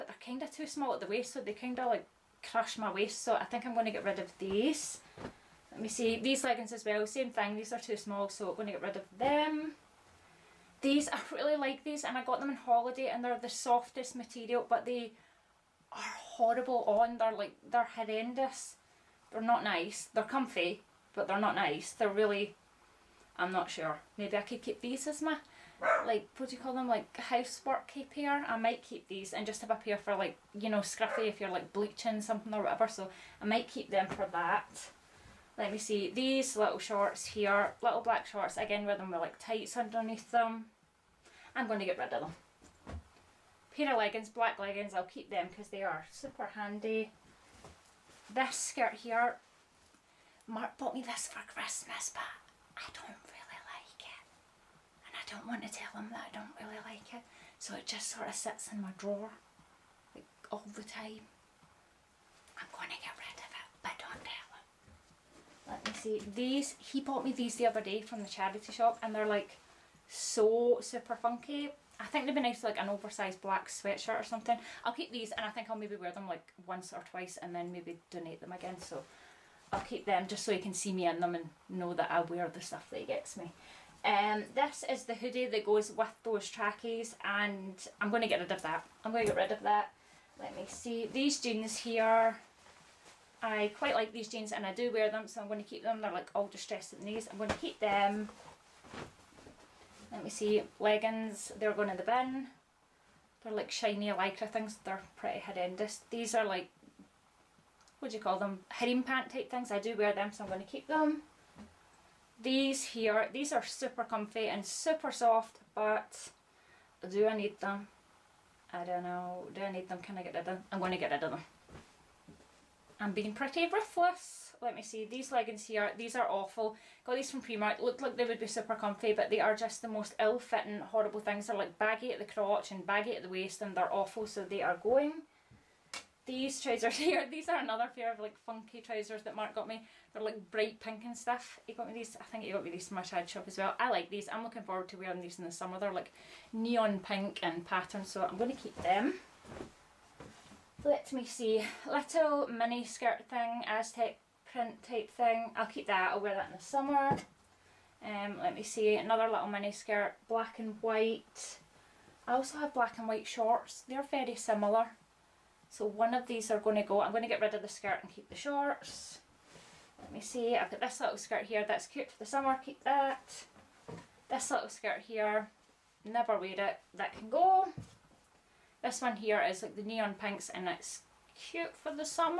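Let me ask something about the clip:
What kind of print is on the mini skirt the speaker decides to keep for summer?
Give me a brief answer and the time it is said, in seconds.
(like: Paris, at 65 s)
Aztec, at 153 s.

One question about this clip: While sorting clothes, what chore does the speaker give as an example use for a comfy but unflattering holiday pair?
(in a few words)
bleaching.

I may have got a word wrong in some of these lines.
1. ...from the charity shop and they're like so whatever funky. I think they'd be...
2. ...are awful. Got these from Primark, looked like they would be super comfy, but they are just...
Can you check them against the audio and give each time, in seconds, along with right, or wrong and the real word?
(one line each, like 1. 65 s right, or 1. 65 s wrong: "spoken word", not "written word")
1. 68 s wrong: "super", not "whatever"
2. 126 s right.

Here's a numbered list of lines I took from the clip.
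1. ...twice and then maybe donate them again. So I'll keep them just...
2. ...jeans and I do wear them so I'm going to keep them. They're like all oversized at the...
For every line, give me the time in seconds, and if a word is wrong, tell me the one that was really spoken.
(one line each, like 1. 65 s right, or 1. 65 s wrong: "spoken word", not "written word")
1. 77 s right
2. 94 s wrong: "distressed", not "oversized".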